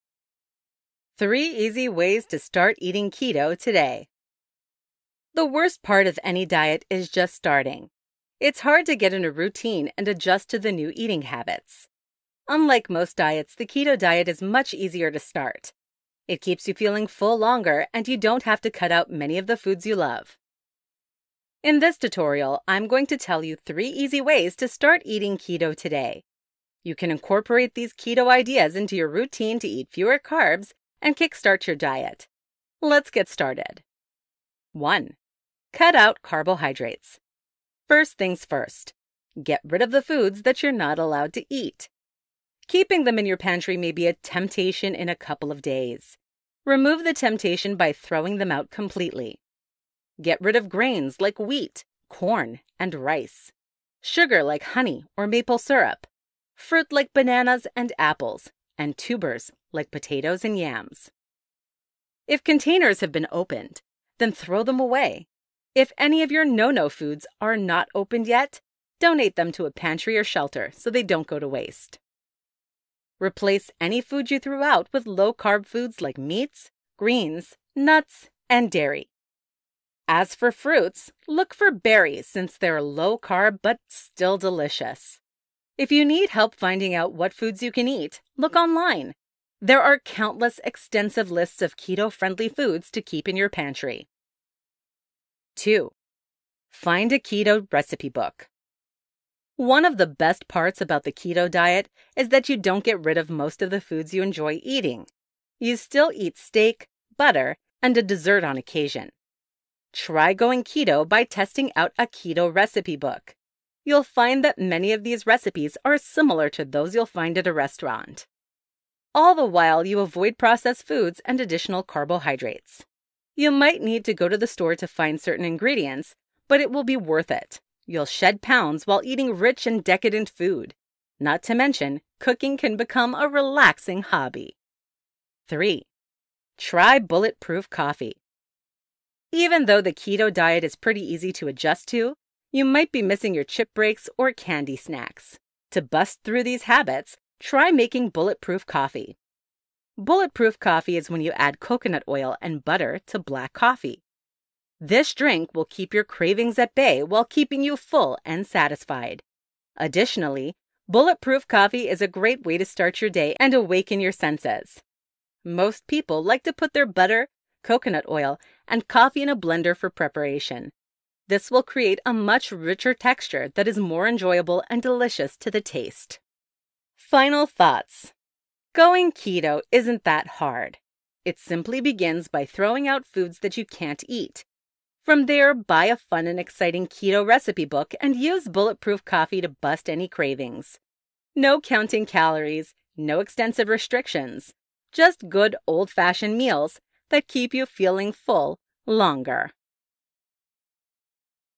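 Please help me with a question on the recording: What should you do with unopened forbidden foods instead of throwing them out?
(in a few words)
Donate them to a pantry or shelter.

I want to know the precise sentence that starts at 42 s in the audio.
Keeping them in your pantry may be a temptation in a couple of days.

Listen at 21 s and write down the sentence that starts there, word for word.
In this tutorial, I'm going to tell you three easy ways to start eating keto today.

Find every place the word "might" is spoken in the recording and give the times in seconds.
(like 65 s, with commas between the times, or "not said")
123 s, 142 s.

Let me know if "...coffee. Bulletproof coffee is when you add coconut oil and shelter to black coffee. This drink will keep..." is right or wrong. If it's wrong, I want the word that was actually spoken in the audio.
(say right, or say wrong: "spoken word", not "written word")
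wrong: "butter", not "shelter".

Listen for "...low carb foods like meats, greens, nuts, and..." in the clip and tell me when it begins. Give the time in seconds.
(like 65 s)
75 s.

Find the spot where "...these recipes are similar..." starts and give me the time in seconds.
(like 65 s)
115 s.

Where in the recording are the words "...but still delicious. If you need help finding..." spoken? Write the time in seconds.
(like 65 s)
83 s.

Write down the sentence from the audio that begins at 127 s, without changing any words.
You'll shed pounds while eating rich and decadent food.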